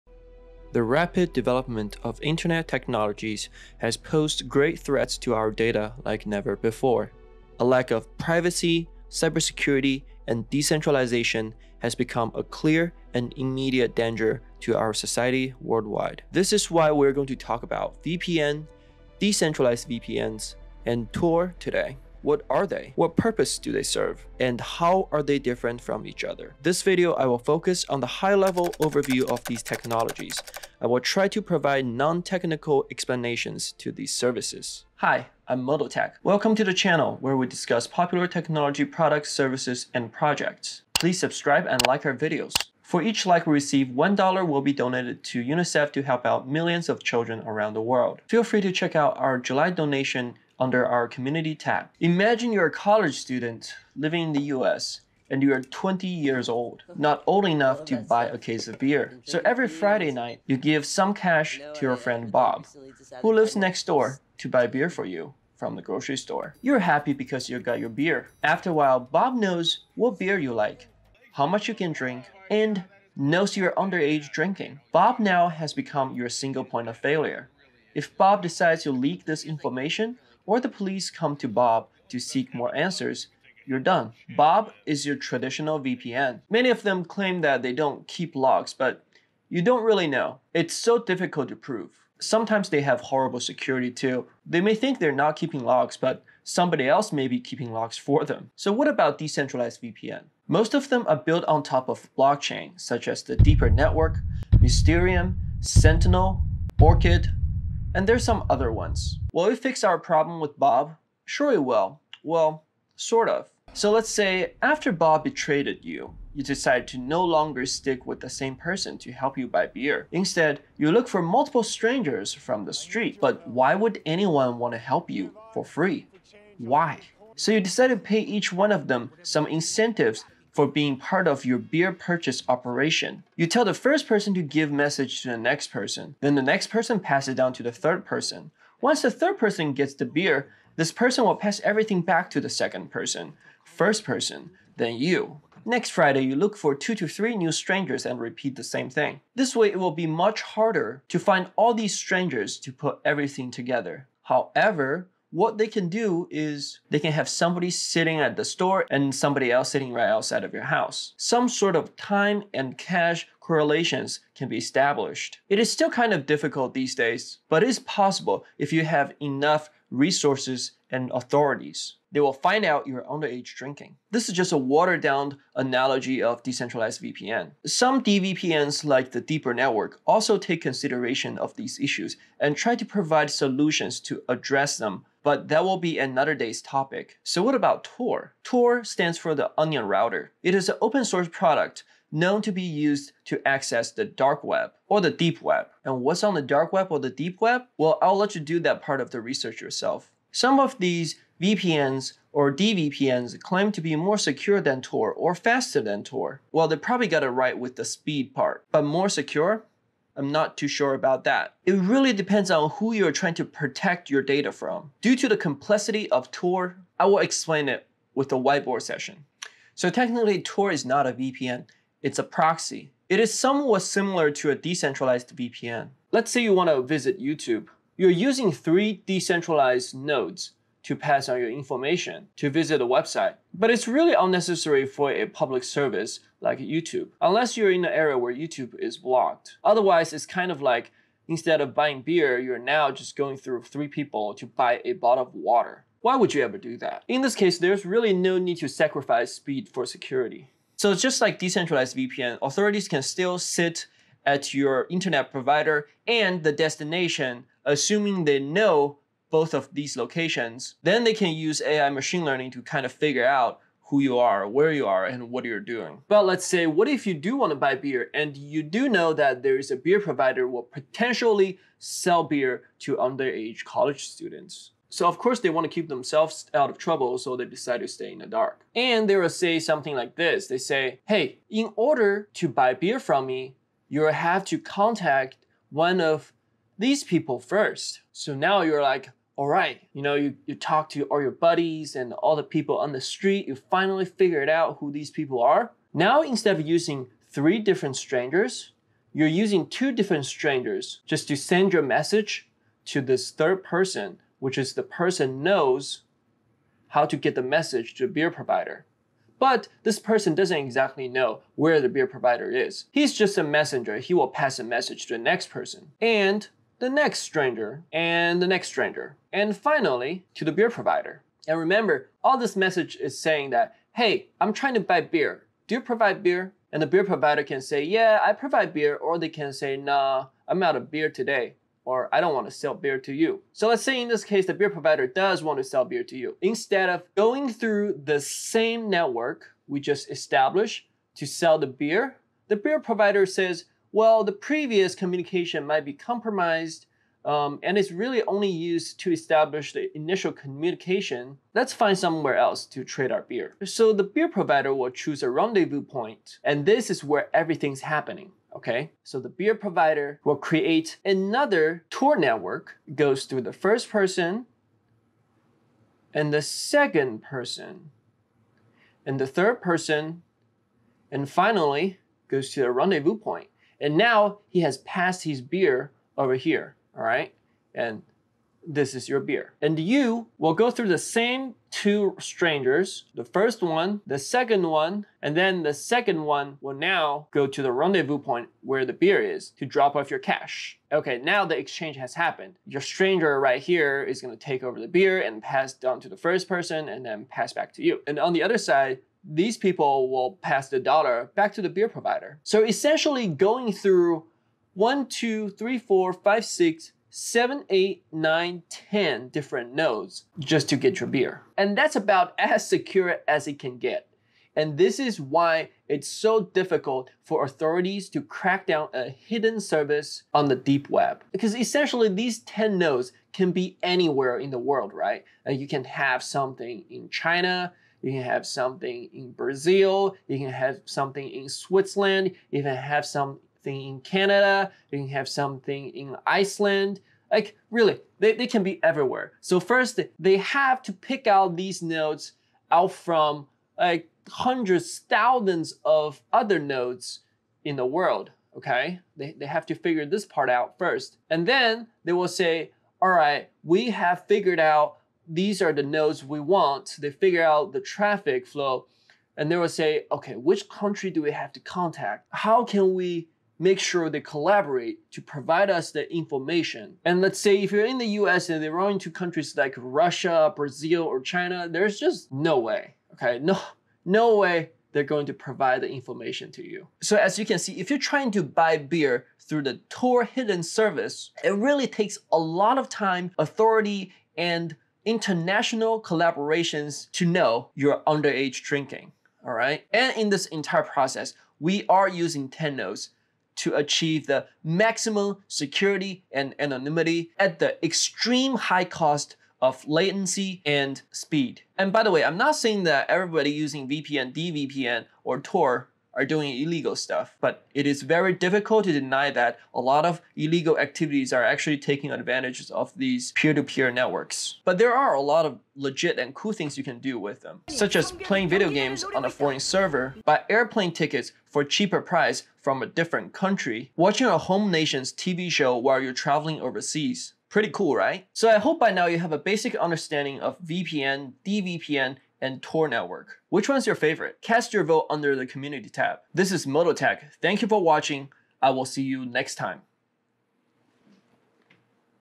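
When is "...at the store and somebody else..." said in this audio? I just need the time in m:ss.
2:38.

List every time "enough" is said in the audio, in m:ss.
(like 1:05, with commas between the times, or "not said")
0:57, 2:49.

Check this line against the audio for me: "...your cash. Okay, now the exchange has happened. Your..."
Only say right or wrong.
right.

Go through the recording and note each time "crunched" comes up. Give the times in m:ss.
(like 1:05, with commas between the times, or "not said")
not said.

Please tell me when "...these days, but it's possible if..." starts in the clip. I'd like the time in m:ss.
2:46.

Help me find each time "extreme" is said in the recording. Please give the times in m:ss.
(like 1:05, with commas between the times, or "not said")
8:17.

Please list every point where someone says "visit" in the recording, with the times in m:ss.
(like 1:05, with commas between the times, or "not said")
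3:46, 3:52.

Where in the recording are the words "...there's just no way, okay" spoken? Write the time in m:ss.
7:51.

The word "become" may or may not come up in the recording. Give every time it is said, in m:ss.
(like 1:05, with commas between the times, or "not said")
0:11, 1:15.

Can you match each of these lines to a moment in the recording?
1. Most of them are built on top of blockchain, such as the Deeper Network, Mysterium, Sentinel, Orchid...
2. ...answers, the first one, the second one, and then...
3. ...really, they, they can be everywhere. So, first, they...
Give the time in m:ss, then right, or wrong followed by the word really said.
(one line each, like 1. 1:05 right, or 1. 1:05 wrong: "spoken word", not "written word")
1. 1:40 right
2. 6:22 wrong: "strangers", not "answers"
3. 7:17 right.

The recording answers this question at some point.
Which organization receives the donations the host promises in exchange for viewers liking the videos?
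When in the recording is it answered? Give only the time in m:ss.
0:45.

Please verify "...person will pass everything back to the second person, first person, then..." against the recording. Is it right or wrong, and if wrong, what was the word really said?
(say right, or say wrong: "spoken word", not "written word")
right.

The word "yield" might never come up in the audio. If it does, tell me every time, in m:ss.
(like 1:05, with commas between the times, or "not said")
not said.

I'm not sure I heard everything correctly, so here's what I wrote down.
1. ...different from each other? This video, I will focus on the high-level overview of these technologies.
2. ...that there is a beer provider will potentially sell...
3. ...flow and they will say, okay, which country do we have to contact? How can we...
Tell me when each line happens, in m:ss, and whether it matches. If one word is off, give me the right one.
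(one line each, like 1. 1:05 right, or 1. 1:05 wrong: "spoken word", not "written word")
1. 0:25 right
2. 4:29 right
3. 7:38 right.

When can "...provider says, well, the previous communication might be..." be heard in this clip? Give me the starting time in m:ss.
5:42.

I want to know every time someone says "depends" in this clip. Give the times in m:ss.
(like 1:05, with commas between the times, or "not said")
3:32.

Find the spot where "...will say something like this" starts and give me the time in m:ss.
4:39.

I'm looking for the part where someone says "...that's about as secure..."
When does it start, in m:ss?
6:51.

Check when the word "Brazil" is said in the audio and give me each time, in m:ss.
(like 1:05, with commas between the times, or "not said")
7:09, 7:50.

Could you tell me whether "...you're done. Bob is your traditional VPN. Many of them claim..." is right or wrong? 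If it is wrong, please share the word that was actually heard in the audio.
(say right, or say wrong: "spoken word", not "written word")
right.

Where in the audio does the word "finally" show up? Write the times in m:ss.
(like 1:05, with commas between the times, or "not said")
4:53, 5:19, 6:11.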